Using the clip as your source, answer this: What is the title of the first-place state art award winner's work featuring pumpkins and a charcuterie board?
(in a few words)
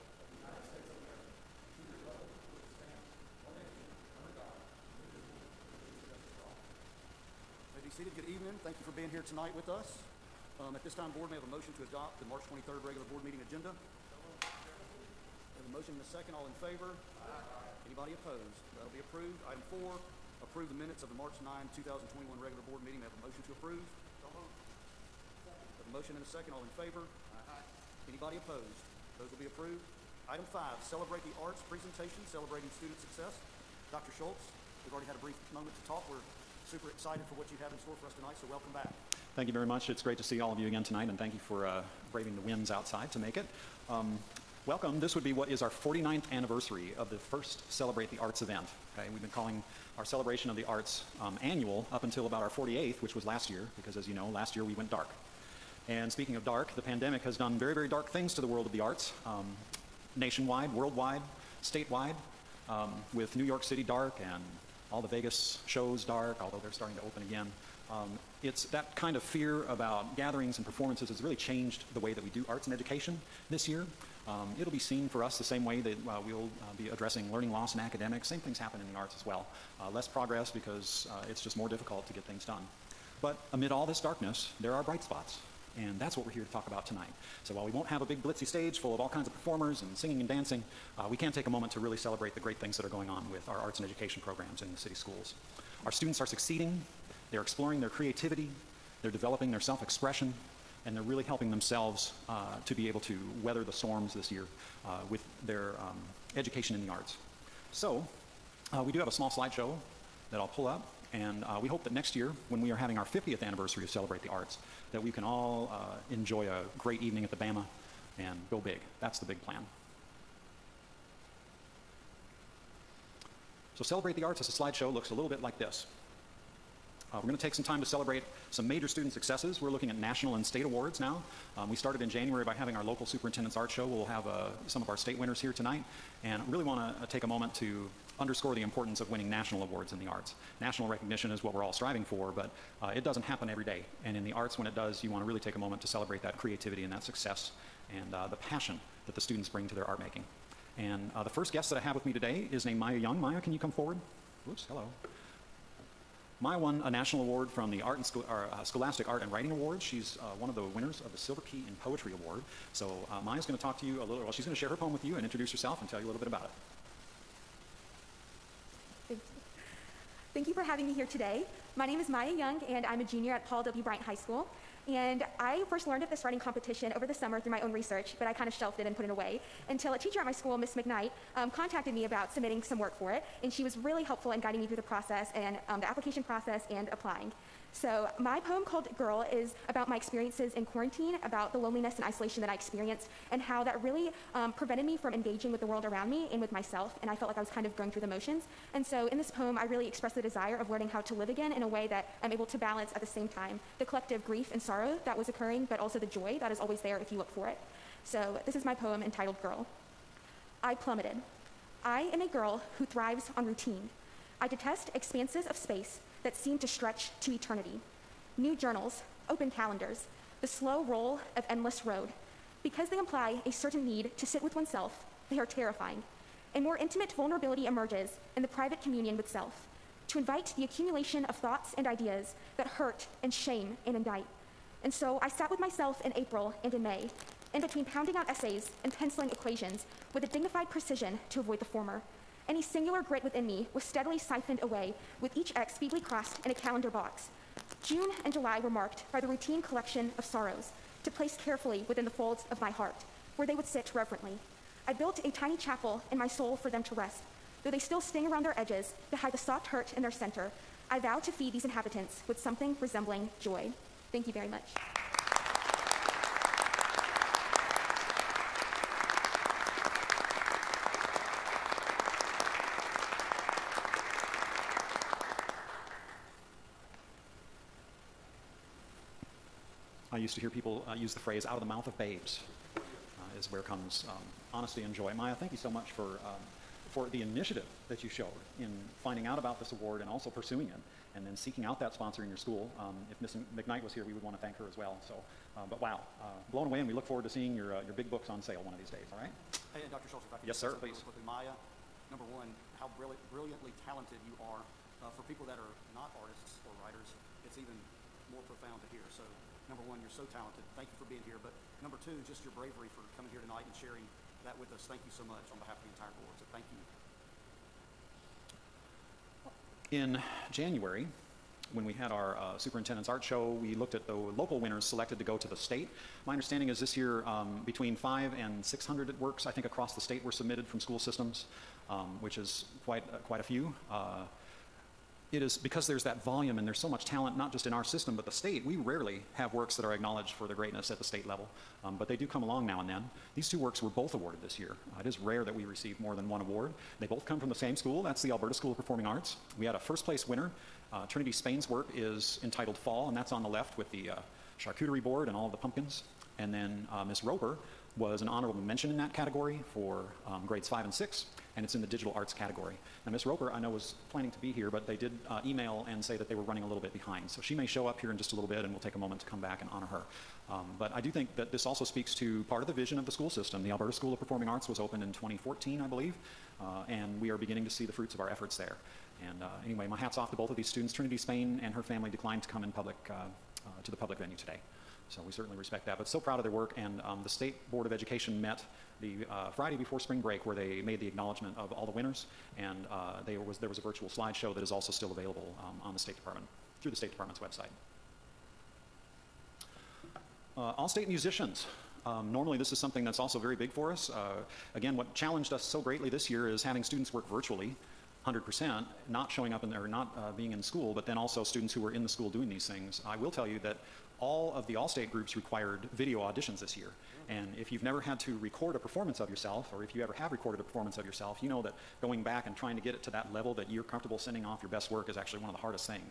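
Fall.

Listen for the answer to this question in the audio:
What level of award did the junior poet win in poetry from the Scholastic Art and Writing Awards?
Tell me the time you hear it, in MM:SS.
02:41.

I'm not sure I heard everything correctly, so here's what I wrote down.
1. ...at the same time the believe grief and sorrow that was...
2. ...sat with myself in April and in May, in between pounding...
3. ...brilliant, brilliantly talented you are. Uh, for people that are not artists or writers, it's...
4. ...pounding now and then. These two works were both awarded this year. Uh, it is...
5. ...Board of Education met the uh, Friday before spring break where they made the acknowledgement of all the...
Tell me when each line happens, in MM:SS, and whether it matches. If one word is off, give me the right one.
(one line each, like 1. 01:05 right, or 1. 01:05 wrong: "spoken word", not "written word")
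1. 03:22 wrong: "collective", not "believe"
2. 03:55 right
3. 05:02 right
4. 05:42 wrong: "along", not "pounding"
5. 06:27 right.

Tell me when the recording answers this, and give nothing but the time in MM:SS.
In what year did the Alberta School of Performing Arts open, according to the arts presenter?
06:15.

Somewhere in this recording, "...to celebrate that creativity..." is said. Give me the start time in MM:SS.
02:25.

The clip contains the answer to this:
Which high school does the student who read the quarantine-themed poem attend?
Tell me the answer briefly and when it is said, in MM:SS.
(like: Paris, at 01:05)
Paul W. Bryant High School, at 02:53.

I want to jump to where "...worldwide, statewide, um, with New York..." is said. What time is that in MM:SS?
01:00.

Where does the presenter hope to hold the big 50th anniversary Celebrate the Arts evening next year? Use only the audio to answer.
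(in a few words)
the Bama.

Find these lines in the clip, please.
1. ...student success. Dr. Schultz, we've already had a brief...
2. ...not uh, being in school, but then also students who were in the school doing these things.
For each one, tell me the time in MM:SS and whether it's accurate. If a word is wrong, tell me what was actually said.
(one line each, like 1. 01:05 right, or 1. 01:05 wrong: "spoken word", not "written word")
1. 00:32 right
2. 06:49 right.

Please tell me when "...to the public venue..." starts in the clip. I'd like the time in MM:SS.
06:23.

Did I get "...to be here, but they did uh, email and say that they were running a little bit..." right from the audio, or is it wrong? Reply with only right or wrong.
right.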